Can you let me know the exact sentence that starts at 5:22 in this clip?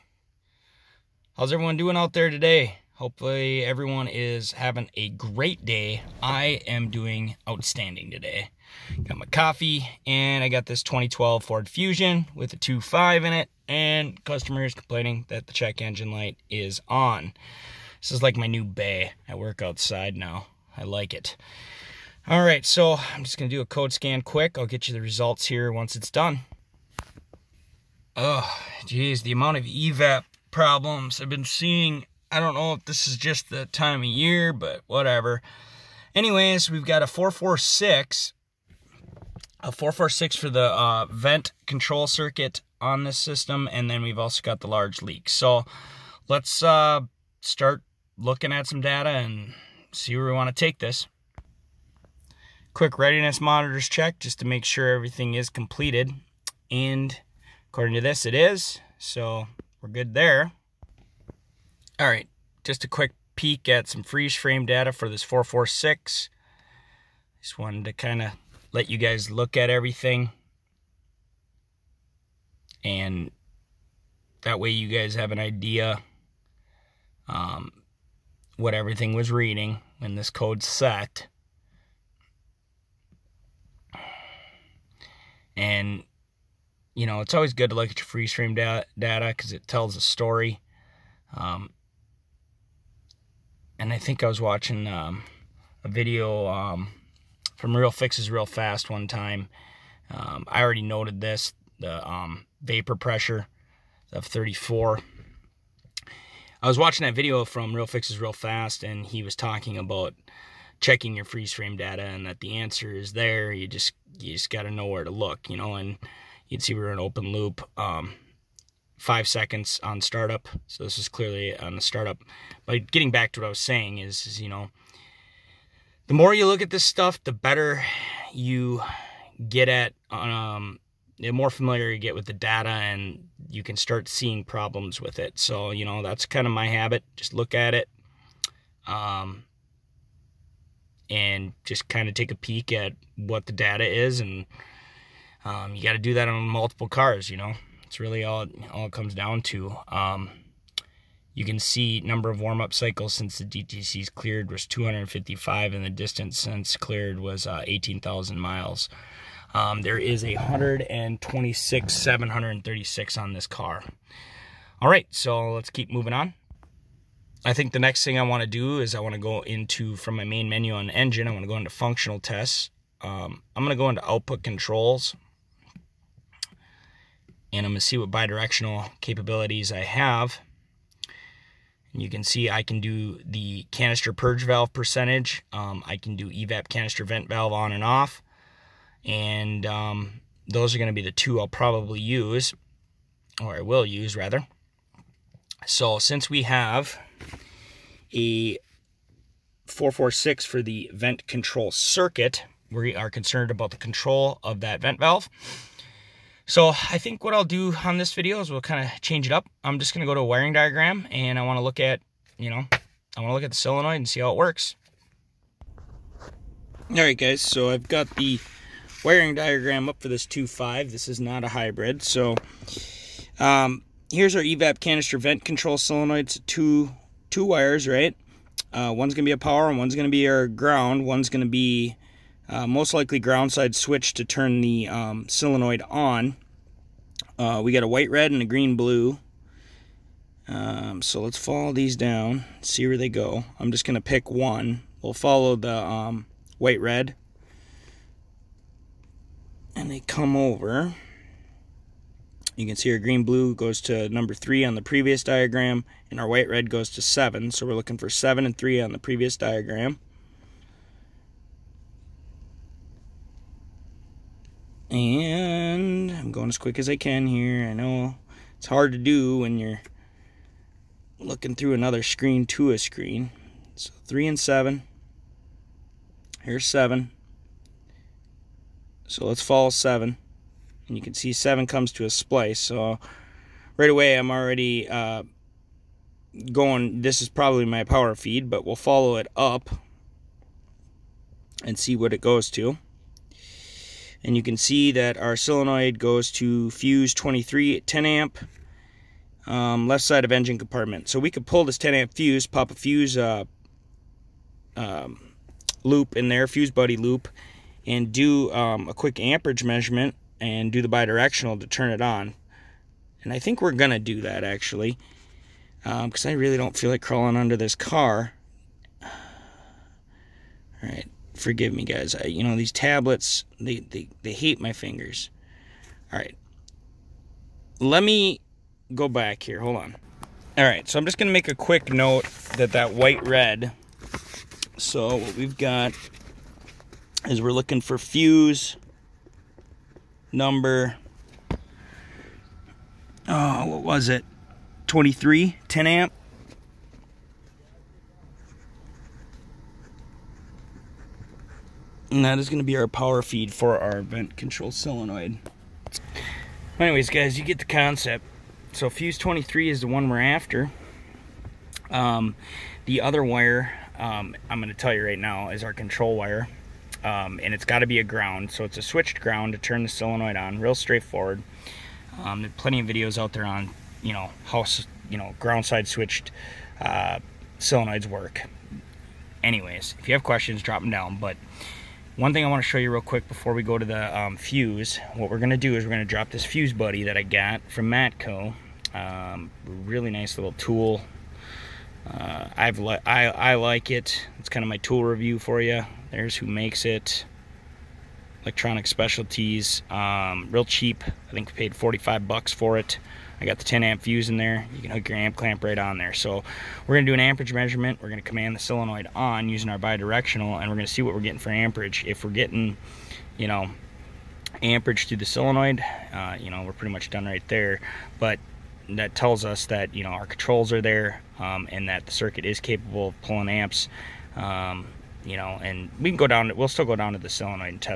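I, you know, these tablets, they, they, they hate my fingers.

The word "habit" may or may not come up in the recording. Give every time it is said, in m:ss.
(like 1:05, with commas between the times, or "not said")
2:16.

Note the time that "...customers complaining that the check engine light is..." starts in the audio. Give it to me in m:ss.
0:14.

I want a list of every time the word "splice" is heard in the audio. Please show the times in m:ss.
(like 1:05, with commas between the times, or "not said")
4:42.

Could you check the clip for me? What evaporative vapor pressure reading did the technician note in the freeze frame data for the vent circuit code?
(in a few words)
34.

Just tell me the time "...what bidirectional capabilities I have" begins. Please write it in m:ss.
2:57.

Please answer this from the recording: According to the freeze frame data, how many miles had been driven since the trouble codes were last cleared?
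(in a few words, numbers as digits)
18,000 miles.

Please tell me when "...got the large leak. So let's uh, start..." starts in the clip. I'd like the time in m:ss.
0:44.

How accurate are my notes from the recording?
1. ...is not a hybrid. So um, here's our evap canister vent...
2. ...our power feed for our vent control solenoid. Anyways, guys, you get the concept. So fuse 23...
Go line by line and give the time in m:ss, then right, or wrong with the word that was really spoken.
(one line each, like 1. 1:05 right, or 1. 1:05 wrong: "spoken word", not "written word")
1. 3:41 right
2. 5:52 right.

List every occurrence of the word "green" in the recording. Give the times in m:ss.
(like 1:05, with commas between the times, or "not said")
3:58, 4:12.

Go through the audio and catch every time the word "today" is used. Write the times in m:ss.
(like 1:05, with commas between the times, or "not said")
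0:02, 0:08.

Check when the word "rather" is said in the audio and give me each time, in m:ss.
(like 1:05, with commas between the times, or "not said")
3:14.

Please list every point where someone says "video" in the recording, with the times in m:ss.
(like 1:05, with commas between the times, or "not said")
1:35, 1:47, 3:28, 6:12.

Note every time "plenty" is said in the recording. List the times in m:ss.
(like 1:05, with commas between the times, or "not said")
6:12.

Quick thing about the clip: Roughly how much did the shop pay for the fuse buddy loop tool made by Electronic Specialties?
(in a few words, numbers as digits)
45 bucks.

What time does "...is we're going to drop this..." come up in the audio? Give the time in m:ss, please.
6:25.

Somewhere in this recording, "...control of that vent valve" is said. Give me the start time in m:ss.
3:23.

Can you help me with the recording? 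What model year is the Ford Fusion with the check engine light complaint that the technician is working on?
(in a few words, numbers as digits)
2012.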